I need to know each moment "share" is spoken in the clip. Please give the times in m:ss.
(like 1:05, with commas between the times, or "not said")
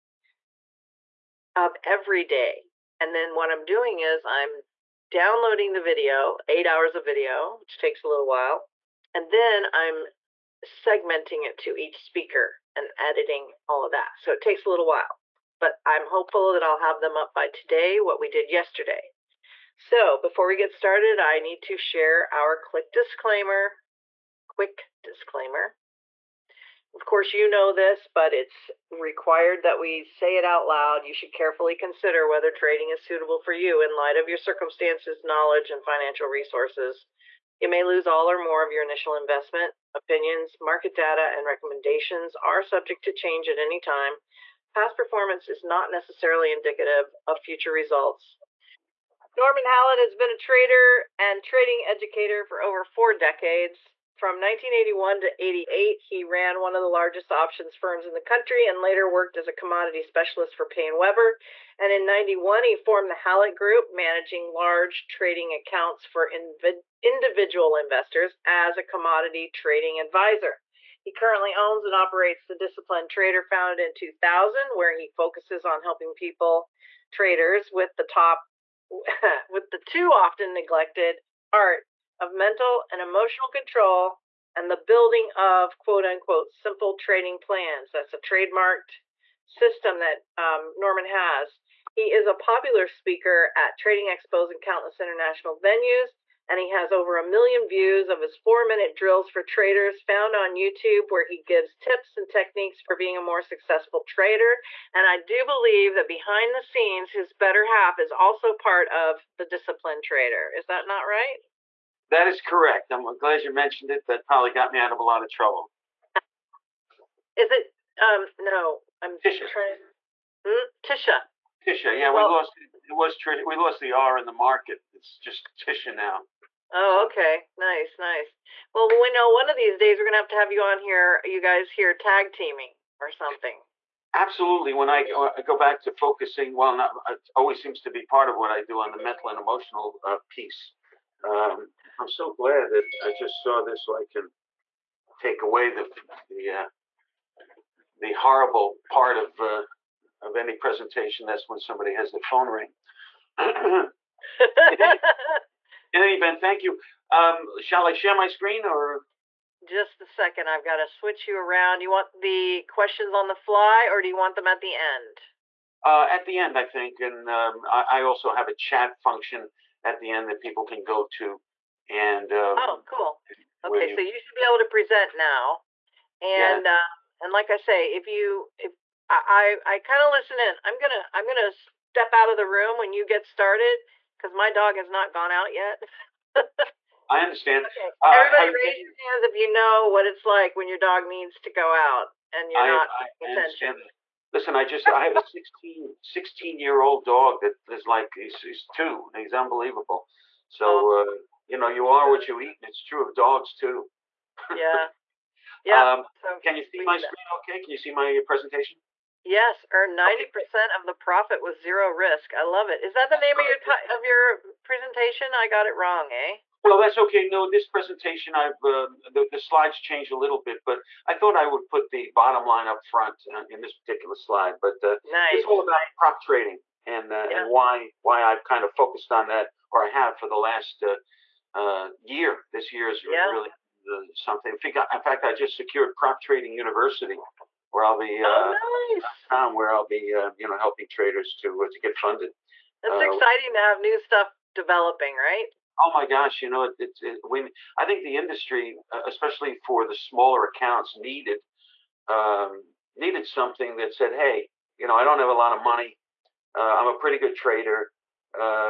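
0:21, 2:37.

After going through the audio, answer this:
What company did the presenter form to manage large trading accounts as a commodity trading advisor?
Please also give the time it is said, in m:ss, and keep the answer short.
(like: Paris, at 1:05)
The Hallett Group, at 1:03.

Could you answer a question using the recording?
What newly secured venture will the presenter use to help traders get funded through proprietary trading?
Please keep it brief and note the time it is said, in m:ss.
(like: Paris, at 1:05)
Prop Trading University, at 3:55.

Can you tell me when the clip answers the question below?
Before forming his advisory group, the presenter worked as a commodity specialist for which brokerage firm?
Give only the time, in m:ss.
1:00.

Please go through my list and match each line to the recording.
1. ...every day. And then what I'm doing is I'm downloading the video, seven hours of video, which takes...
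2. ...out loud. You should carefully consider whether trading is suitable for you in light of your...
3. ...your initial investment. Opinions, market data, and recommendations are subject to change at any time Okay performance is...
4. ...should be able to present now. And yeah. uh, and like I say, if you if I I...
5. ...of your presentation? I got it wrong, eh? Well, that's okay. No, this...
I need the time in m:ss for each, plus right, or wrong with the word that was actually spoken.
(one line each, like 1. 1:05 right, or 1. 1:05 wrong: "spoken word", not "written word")
1. 0:01 wrong: "eight", not "seven"
2. 0:30 right
3. 0:38 wrong: "Past", not "Okay"
4. 2:54 right
5. 3:33 right.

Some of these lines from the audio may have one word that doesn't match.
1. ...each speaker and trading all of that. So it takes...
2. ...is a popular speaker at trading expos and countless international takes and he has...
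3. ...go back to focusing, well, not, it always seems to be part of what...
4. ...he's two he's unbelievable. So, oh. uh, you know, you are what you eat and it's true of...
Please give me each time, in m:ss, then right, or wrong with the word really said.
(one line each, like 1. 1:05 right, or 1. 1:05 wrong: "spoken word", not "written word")
1. 0:11 wrong: "editing", not "trading"
2. 1:32 wrong: "venues", not "takes"
3. 2:15 right
4. 3:18 right.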